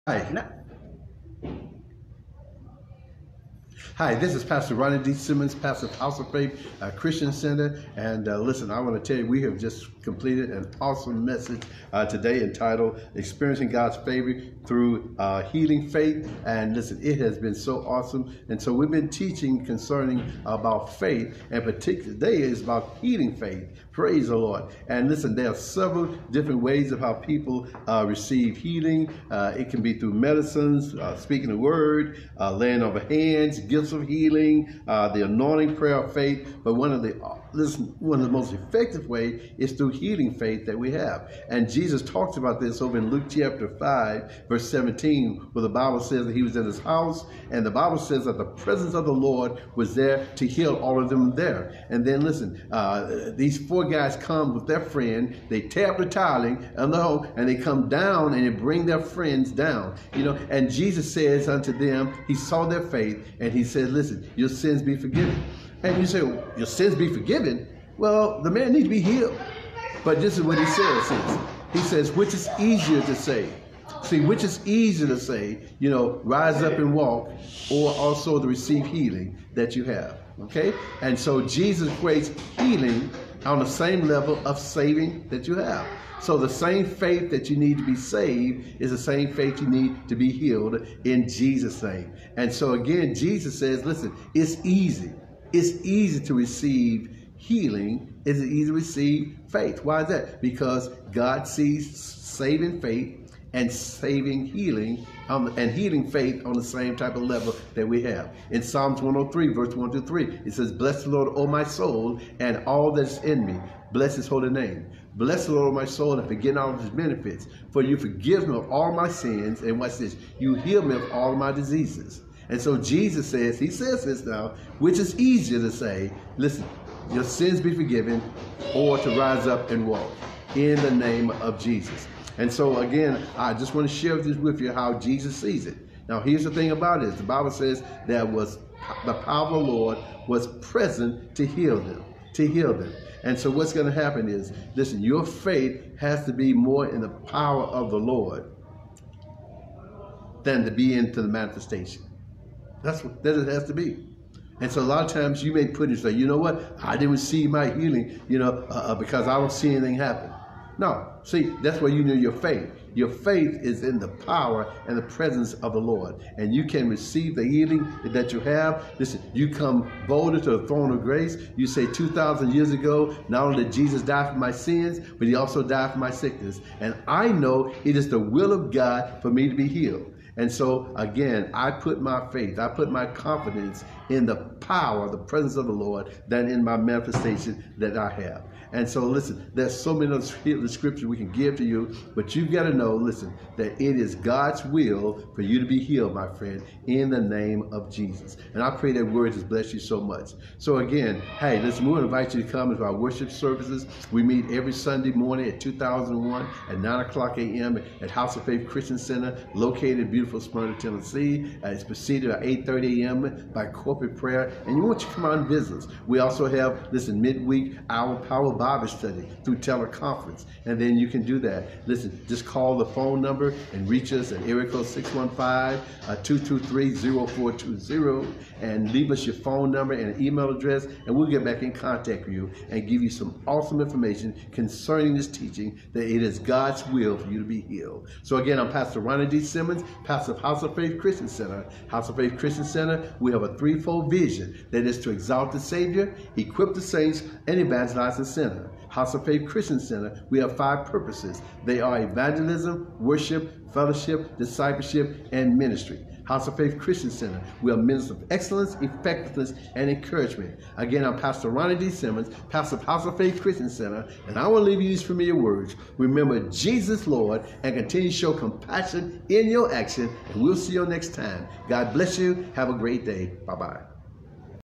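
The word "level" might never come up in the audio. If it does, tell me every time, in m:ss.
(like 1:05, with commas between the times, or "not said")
1:24, 1:47.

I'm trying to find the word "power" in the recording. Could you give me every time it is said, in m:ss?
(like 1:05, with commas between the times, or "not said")
2:19, 2:27, 2:44, 3:04, 3:38.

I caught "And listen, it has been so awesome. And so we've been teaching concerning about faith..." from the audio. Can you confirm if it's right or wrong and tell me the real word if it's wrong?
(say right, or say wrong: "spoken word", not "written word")
right.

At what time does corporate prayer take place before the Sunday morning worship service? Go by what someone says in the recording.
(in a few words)
8:30 a.m.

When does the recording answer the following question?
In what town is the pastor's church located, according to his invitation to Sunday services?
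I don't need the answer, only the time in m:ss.
3:30.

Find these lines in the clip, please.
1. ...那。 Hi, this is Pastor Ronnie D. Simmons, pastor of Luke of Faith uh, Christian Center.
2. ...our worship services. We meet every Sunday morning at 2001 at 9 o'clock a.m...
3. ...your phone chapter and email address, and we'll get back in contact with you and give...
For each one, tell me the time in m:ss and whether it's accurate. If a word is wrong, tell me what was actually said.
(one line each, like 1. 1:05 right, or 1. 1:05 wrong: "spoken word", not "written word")
1. 0:00 wrong: "House", not "Luke"
2. 3:22 right
3. 3:49 wrong: "number", not "chapter".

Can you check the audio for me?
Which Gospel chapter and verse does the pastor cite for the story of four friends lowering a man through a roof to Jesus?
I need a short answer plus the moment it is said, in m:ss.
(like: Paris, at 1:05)
Luke 5:17, at 0:43.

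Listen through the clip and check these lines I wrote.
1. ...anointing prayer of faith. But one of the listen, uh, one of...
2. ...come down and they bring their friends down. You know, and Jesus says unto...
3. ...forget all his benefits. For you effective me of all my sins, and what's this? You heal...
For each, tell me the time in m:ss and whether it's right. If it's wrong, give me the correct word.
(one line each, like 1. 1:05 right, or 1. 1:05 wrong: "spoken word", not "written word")
1. 0:35 right
2. 0:57 right
3. 1:56 wrong: "forgive", not "effective".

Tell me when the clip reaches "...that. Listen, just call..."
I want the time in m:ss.
3:41.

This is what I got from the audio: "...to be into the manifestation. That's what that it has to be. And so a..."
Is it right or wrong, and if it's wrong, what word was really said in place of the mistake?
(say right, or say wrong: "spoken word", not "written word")
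right.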